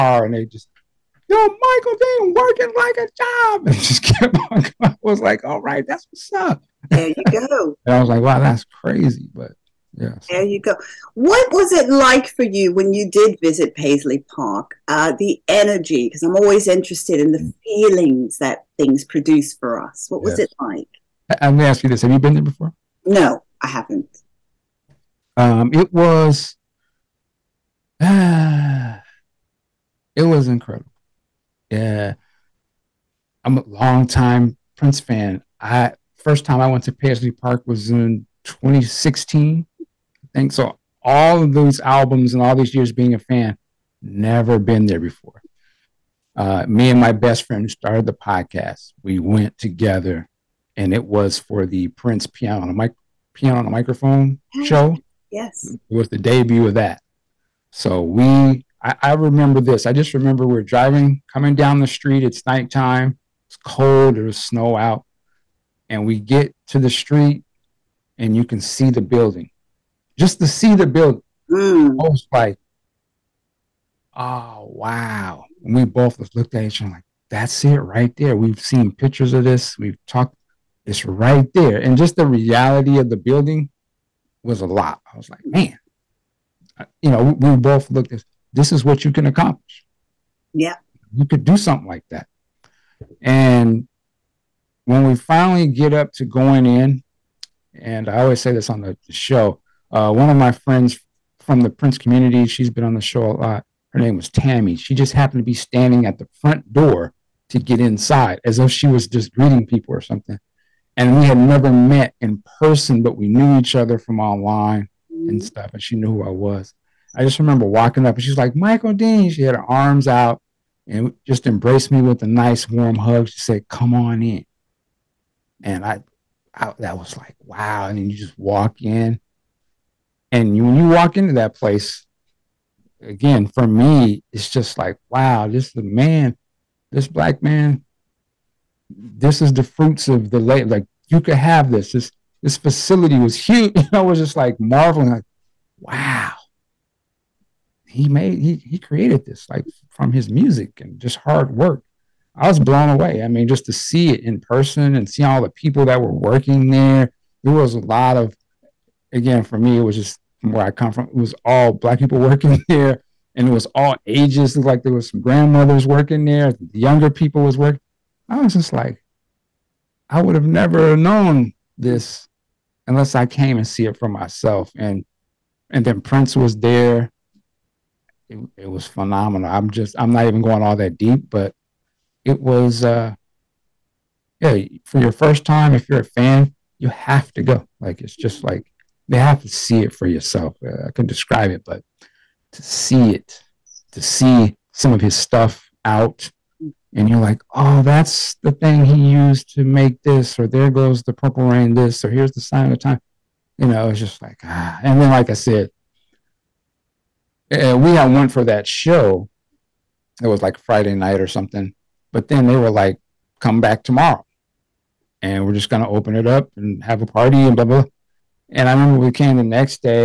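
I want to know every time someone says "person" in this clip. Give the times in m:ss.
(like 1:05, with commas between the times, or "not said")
1:52, 2:34.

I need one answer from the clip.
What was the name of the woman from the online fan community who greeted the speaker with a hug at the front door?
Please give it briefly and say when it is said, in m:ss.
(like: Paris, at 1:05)
Tammy, at 1:44.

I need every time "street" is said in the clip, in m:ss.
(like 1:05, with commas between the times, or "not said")
1:01, 1:06.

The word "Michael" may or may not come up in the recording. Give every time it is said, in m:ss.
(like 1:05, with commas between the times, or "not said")
0:01, 1:58.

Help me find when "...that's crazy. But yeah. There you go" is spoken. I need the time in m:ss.
0:08.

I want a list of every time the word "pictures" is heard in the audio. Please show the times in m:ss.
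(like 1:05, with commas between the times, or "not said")
1:18.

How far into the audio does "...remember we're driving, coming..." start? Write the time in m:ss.
1:00.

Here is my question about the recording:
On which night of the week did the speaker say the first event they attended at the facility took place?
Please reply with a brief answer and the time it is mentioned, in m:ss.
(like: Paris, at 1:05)
Friday night, at 3:30.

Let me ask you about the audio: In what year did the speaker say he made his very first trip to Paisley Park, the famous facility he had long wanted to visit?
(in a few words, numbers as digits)
2016.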